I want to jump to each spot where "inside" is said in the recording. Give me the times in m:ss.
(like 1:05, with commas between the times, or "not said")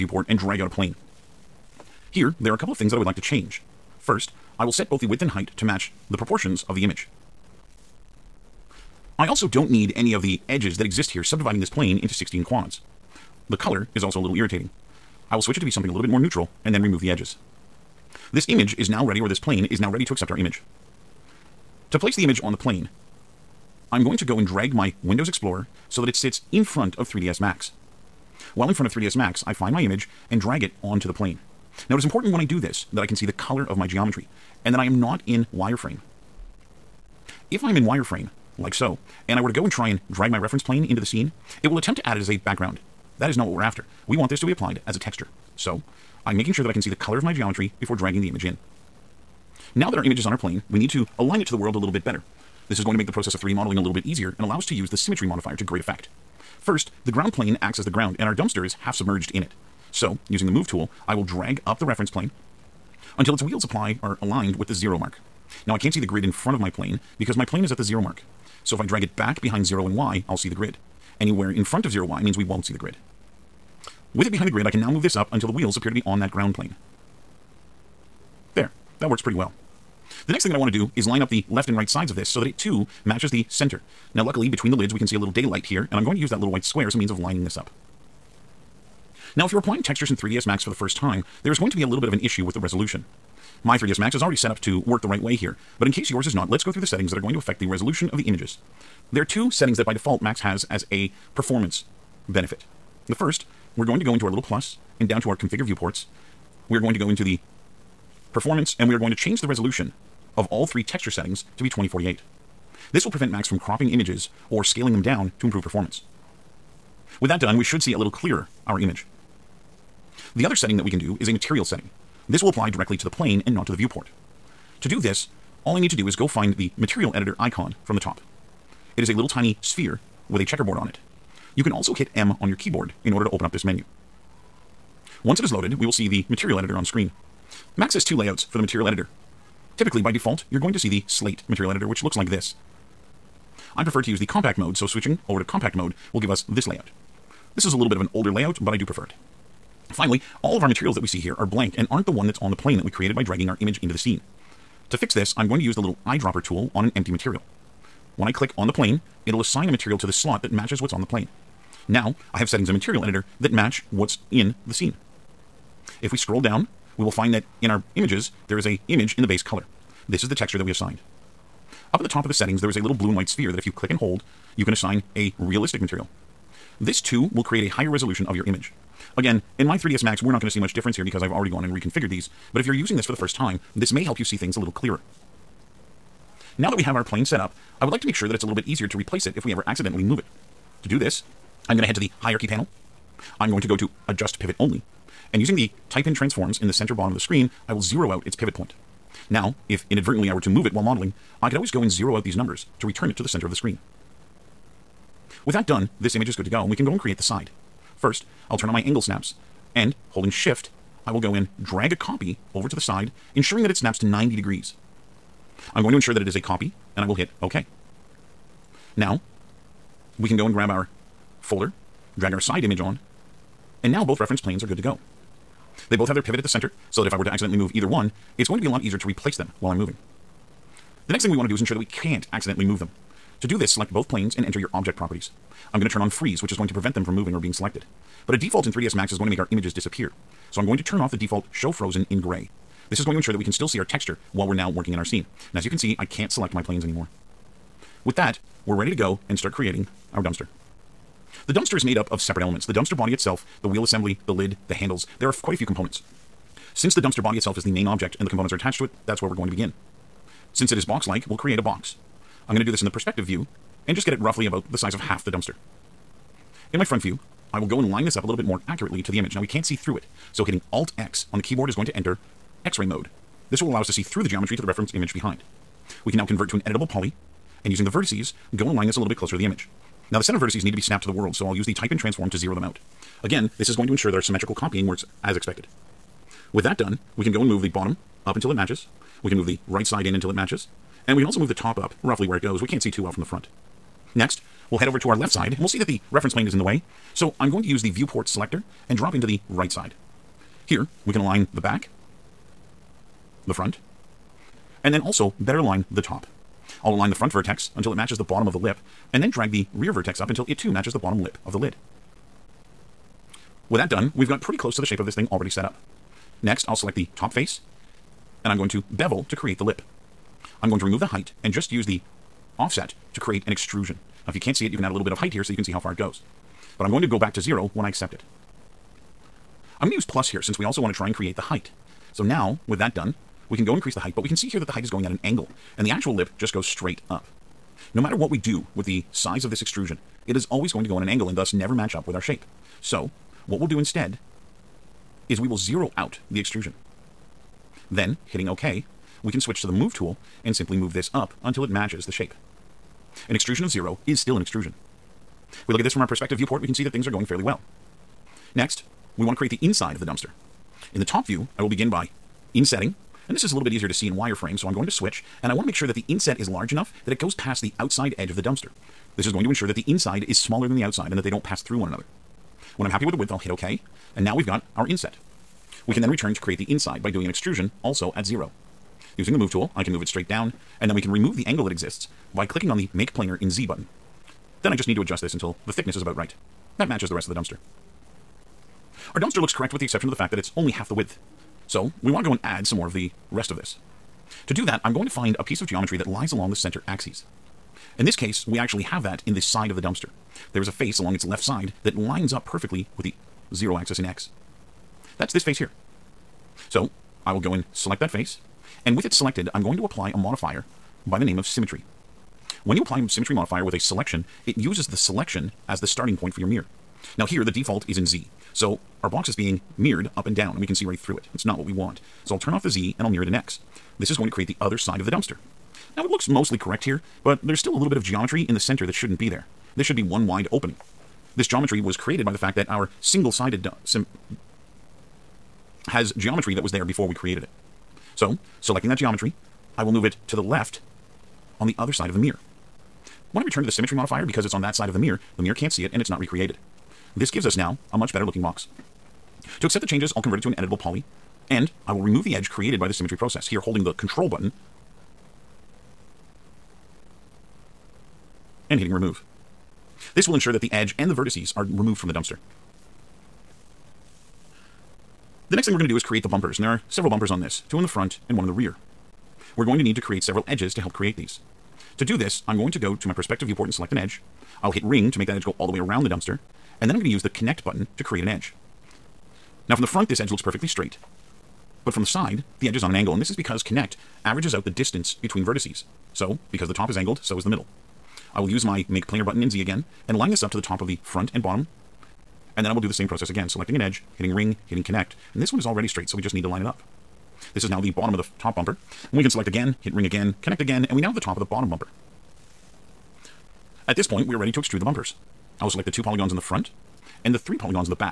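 5:59, 6:09, 6:16.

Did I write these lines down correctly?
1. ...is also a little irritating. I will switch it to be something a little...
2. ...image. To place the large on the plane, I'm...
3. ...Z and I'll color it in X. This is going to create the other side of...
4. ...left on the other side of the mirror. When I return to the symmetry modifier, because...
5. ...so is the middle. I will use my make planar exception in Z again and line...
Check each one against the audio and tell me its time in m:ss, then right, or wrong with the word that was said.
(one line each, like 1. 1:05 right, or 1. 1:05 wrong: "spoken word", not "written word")
1. 0:13 right
2. 0:20 wrong: "image", not "large"
3. 7:02 wrong: "mirror", not "color"
4. 7:20 right
5. 8:07 wrong: "button", not "exception".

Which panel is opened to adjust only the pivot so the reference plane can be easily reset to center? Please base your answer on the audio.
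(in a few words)
Hierarchy panel.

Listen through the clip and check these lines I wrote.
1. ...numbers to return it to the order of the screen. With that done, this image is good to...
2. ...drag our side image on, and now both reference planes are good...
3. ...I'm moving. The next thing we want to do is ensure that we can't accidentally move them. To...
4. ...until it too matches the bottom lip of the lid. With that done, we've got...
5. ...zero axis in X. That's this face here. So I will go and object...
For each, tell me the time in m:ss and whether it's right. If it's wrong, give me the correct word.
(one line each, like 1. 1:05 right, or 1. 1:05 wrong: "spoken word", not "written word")
1. 3:22 wrong: "center", not "order"
2. 3:42 right
3. 3:49 right
4. 5:10 right
5. 6:43 wrong: "select", not "object".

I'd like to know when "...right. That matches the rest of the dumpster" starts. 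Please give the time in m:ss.
6:26.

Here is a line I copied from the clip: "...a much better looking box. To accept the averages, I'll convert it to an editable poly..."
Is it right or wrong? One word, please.
wrong.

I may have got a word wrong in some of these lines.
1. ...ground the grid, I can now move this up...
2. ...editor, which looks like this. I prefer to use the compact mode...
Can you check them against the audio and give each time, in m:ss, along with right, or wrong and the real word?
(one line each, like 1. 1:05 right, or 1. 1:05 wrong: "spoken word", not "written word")
1. 1:14 wrong: "behind", not "ground"
2. 2:21 right.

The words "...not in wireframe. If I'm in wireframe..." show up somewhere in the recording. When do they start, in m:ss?
0:35.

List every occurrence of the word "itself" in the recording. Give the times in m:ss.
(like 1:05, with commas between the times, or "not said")
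4:13, 4:17.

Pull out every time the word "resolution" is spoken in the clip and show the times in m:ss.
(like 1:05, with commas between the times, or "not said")
1:32, 1:37, 1:49, 2:57.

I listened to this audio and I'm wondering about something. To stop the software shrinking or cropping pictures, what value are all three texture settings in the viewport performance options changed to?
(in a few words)
2048.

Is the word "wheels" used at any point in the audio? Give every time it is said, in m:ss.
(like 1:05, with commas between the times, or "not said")
1:03, 1:15, 4:13.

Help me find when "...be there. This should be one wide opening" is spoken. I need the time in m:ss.
7:09.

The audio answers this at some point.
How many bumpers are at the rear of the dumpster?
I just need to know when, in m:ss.
7:48.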